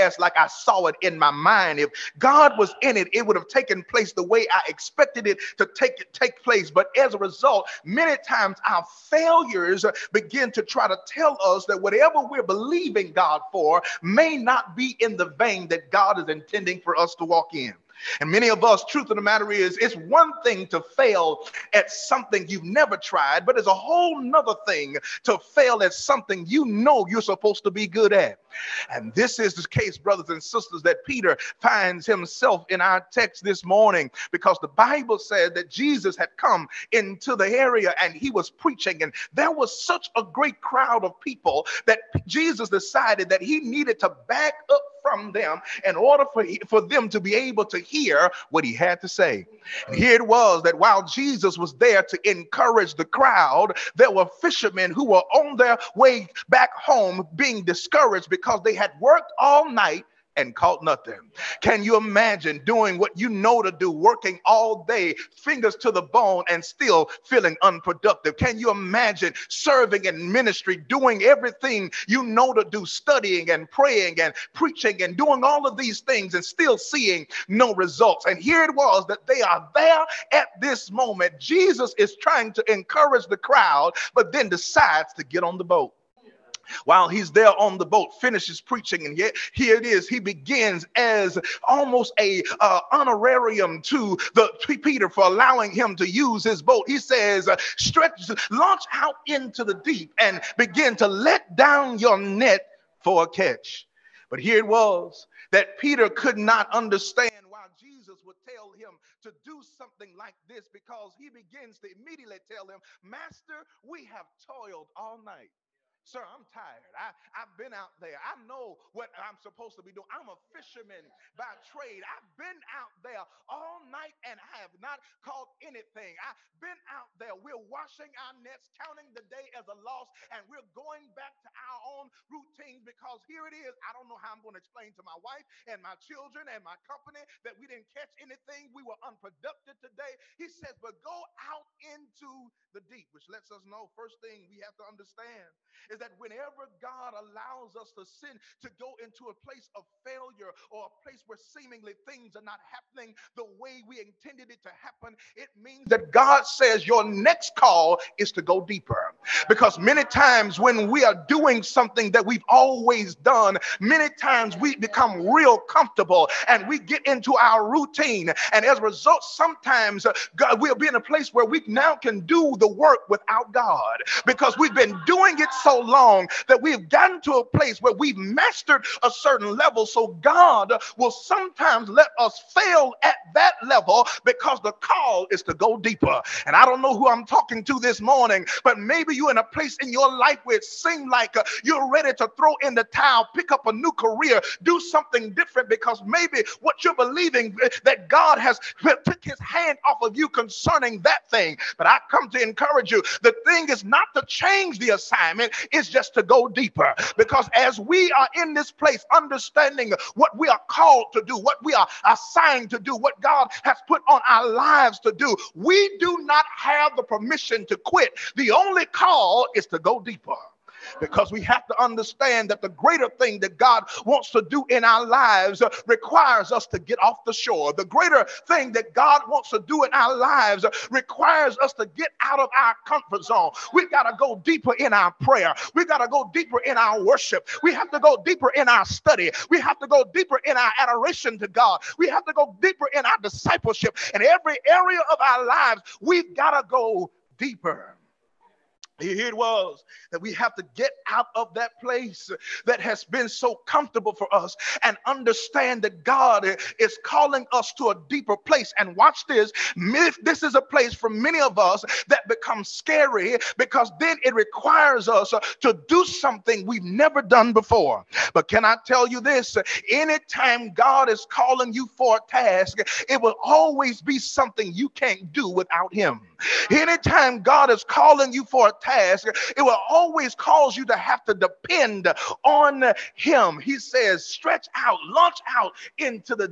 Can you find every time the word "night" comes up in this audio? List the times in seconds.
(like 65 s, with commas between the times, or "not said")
59 s, 115 s, 123 s.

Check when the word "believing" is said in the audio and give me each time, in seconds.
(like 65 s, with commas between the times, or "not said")
12 s, 196 s.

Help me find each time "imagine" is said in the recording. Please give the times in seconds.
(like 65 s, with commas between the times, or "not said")
61 s, 68 s.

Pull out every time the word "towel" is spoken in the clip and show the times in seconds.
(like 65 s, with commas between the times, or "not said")
192 s.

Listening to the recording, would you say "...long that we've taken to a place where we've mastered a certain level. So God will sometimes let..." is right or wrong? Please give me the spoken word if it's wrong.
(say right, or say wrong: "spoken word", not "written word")
wrong: "gotten", not "taken".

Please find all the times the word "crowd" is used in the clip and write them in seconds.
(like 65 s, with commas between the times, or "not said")
40 s, 53 s, 83 s.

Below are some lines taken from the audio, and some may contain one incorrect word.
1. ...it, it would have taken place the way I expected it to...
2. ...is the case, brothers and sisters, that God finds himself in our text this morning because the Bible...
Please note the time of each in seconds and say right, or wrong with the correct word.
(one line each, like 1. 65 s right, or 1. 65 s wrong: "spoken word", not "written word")
1. 2 s right
2. 29 s wrong: "Peter", not "God".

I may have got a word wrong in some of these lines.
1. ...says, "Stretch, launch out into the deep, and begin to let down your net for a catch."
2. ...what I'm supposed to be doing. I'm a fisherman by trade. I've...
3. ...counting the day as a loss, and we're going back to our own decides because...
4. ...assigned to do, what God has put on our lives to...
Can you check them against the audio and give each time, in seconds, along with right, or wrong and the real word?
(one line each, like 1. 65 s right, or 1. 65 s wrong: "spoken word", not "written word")
1. 96 s right
2. 118 s right
3. 128 s wrong: "routines", not "decides"
4. 212 s right.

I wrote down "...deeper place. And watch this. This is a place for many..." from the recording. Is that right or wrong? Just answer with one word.
right.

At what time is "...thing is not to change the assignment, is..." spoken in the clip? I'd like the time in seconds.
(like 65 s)
203 s.